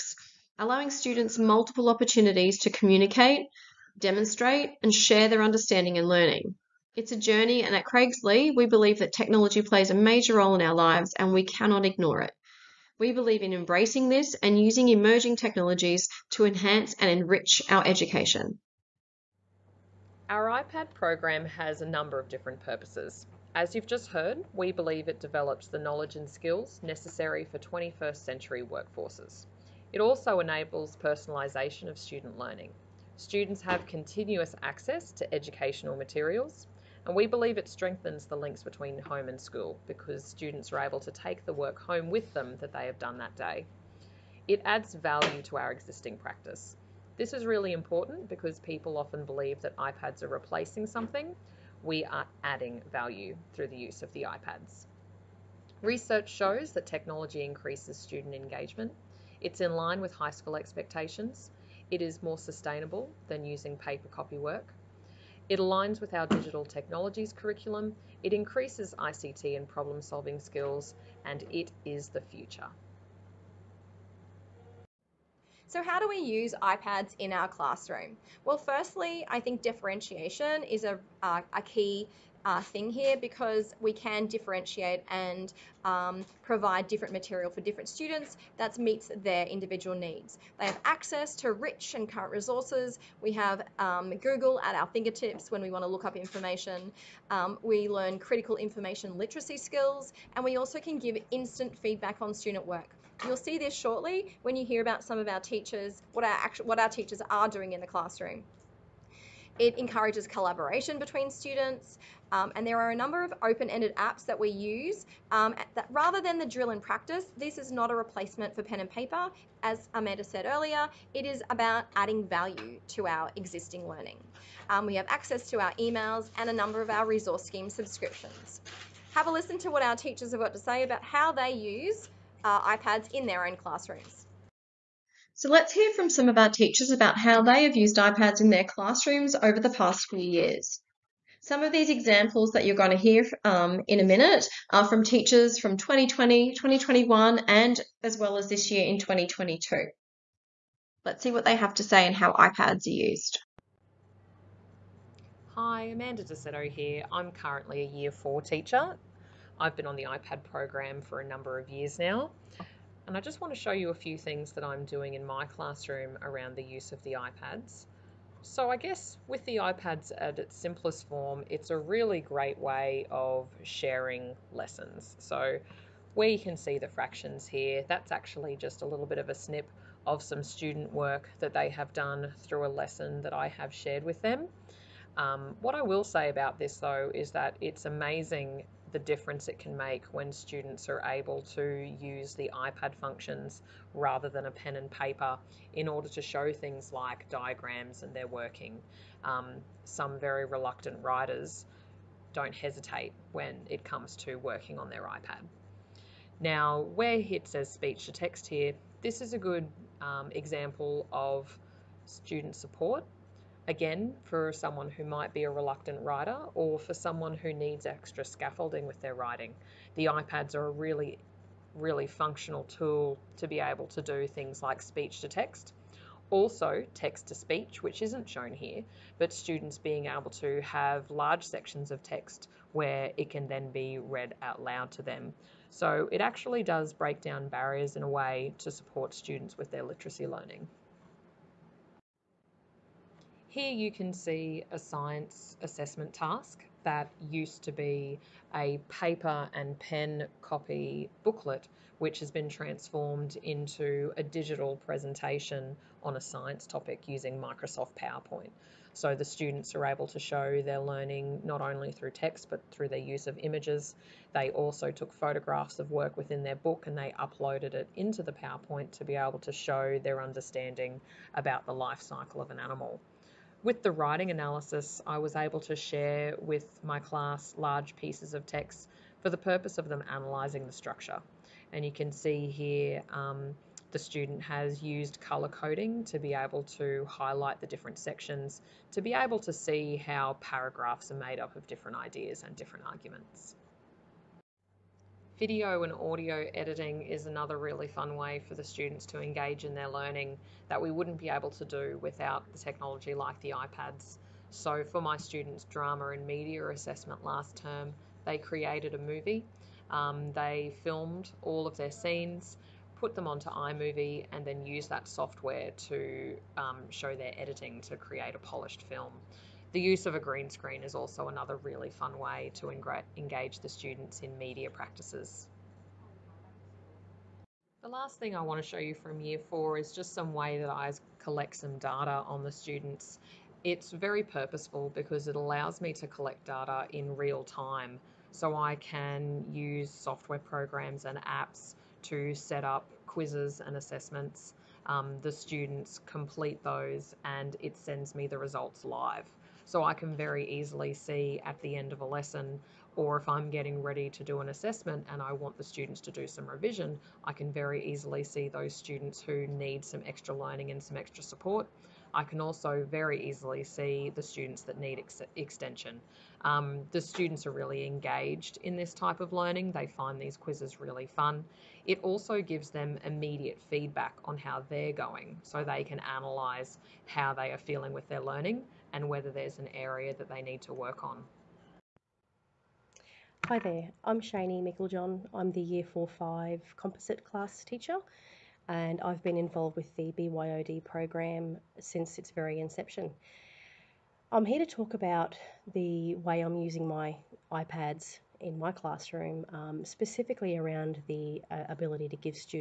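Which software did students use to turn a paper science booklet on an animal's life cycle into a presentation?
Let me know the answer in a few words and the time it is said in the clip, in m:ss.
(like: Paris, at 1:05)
Microsoft PowerPoint, at 4:17.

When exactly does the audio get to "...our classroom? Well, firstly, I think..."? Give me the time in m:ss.
1:17.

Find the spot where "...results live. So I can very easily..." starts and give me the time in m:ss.
5:48.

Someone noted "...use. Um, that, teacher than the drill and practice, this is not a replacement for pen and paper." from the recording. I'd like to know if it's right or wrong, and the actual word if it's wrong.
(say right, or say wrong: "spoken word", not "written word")
wrong: "rather", not "teacher".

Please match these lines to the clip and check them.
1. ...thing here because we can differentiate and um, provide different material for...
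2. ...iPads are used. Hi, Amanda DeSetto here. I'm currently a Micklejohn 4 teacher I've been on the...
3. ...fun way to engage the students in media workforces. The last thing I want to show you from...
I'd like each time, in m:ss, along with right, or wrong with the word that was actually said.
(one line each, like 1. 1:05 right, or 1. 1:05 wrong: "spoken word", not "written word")
1. 1:22 right
2. 2:32 wrong: "Year", not "Micklejohn"
3. 5:21 wrong: "practices", not "workforces".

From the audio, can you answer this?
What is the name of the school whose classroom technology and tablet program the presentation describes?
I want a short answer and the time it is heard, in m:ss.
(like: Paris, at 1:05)
Craigslea, at 0:07.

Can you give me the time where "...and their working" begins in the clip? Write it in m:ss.
3:18.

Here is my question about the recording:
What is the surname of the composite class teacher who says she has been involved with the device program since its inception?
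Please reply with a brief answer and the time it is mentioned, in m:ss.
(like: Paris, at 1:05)
Micklejohn, at 6:24.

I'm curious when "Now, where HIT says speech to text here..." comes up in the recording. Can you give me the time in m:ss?
3:26.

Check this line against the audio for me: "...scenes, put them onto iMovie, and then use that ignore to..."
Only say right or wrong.
wrong.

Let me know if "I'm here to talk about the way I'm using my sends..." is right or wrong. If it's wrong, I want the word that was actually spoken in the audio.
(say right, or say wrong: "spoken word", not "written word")
wrong: "iPads", not "sends".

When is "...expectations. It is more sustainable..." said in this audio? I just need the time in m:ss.
1:00.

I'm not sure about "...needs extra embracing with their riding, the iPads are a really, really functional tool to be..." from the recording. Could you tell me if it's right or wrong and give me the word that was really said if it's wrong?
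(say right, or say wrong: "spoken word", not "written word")
wrong: "scaffolding", not "embracing".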